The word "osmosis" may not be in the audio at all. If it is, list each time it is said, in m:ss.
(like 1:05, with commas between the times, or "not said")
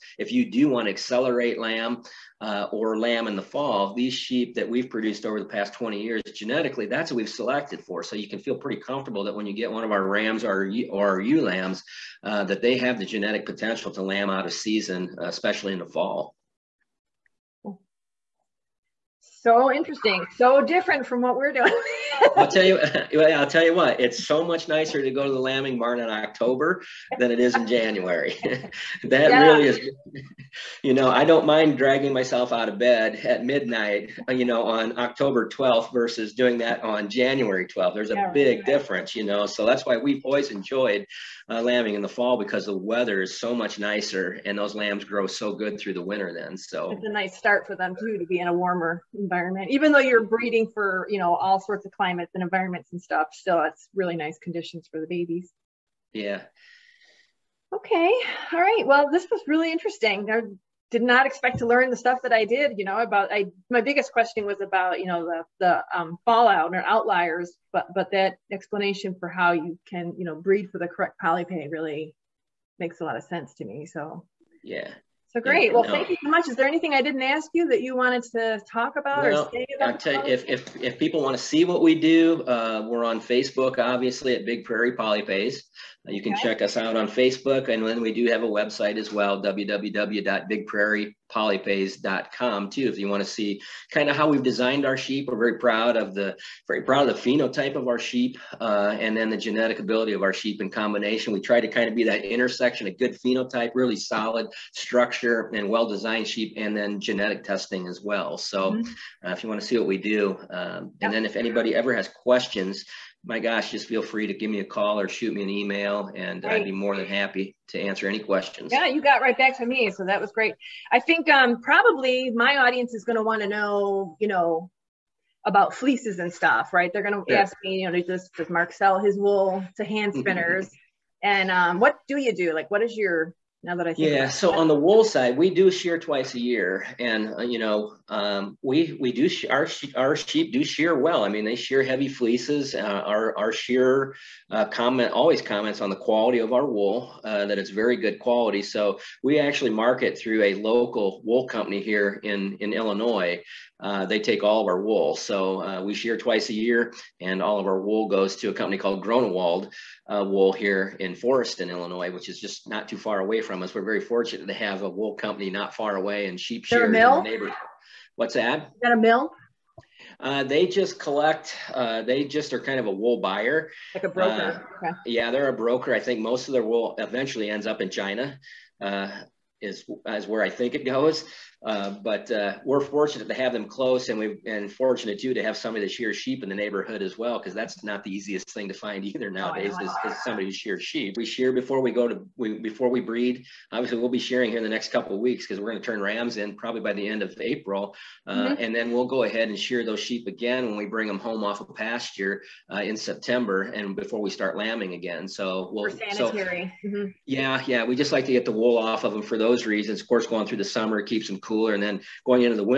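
not said.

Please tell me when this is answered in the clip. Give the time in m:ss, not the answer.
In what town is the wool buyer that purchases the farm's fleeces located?
2:41.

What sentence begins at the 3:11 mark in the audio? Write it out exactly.
We shear before we go to we, before we breed.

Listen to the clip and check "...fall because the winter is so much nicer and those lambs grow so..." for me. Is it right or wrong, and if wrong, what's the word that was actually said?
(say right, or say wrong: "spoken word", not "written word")
wrong: "weather", not "winter".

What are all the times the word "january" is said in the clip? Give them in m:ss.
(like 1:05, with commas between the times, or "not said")
0:27, 0:37.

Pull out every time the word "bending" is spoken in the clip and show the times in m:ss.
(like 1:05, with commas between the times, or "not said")
not said.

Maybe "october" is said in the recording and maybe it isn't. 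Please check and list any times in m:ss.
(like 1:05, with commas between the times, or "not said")
0:26, 0:34.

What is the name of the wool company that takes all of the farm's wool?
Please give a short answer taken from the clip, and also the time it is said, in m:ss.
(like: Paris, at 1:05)
Gronewold, at 2:39.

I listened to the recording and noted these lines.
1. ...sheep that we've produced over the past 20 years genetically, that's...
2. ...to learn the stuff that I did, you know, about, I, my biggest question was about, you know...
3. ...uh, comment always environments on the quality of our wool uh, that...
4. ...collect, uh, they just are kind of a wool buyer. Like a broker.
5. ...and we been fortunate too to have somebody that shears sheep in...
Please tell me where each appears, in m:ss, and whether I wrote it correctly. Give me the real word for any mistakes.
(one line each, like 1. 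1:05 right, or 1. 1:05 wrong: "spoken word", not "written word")
1. 0:04 right
2. 1:01 right
3. 2:24 wrong: "comments", not "environments"
4. 2:50 right
5. 3:04 right.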